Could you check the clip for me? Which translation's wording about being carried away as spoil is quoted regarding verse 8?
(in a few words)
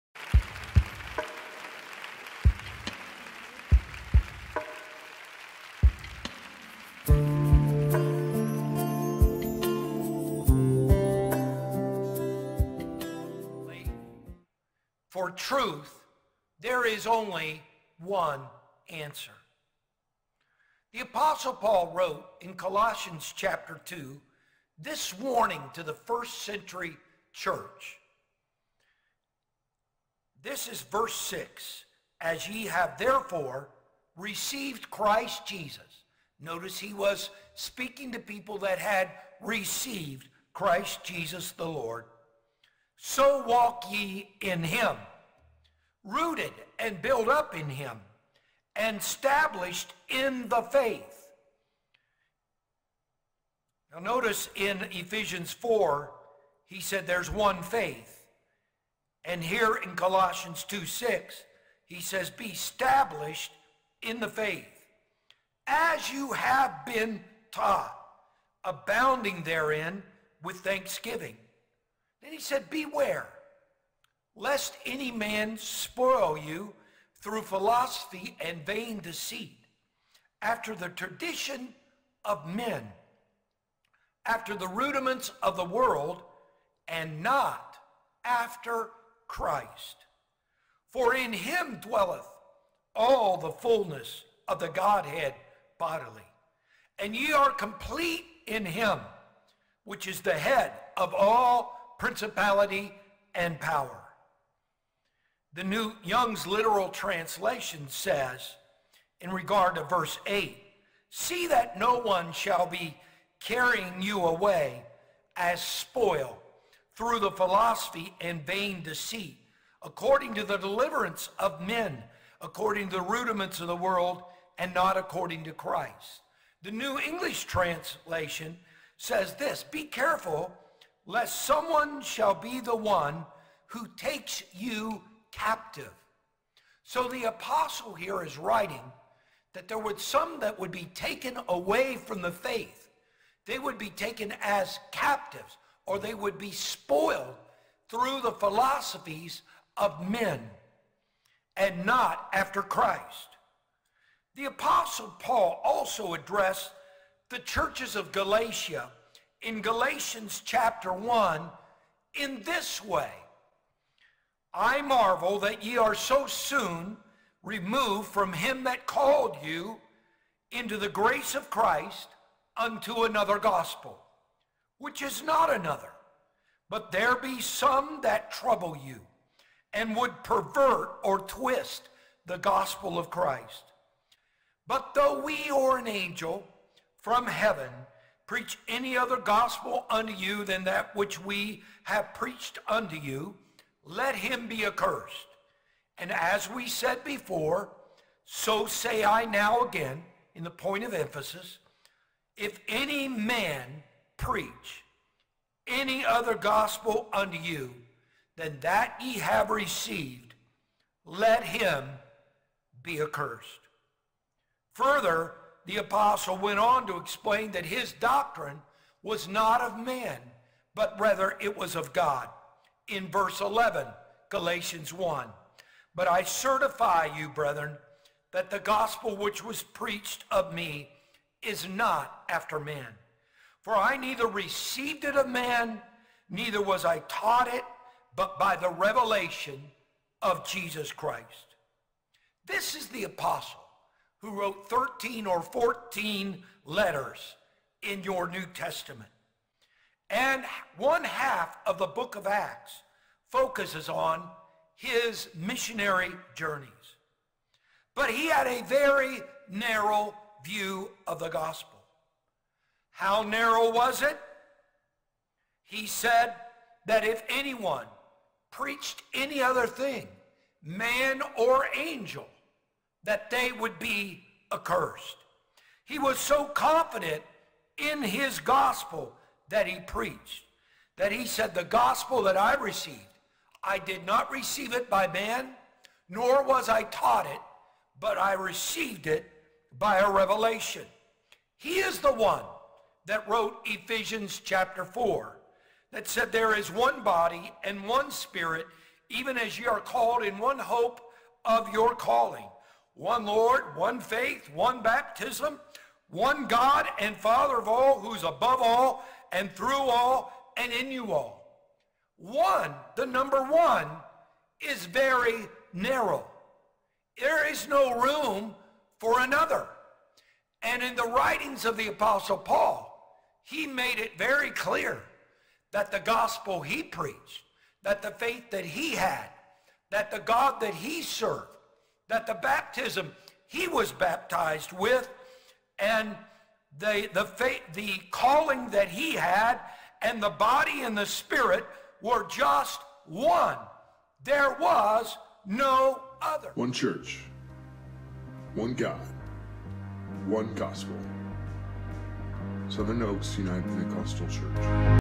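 New Young's literal translation.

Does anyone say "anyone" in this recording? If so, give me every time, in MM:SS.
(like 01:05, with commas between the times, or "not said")
04:27.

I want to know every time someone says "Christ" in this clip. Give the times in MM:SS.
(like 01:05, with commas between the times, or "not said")
00:34, 00:40, 01:29, 02:05, 02:32, 02:51, 03:03, 04:00.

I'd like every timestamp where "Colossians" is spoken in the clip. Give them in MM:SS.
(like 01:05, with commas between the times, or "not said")
00:22, 00:59.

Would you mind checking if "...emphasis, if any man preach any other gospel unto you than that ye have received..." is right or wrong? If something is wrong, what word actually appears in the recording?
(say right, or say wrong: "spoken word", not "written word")
right.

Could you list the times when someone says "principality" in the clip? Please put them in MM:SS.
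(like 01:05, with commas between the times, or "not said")
01:42.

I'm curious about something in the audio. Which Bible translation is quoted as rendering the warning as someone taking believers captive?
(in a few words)
New English translation.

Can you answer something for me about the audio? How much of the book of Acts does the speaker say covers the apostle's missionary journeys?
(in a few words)
One half.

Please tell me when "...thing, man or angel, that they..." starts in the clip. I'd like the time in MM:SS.
04:29.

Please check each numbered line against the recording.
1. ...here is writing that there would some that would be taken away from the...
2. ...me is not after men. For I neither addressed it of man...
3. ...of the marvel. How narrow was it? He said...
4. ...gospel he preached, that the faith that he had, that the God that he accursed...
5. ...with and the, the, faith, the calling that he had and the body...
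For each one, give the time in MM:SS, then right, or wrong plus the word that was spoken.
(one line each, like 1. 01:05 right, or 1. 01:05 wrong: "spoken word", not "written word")
1. 02:17 right
2. 03:50 wrong: "received", not "addressed"
3. 04:21 wrong: "gospel", not "marvel"
4. 05:25 wrong: "served", not "accursed"
5. 05:34 right.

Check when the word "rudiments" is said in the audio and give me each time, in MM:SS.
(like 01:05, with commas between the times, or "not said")
01:24, 02:03.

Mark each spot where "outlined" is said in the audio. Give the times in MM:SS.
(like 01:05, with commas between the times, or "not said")
not said.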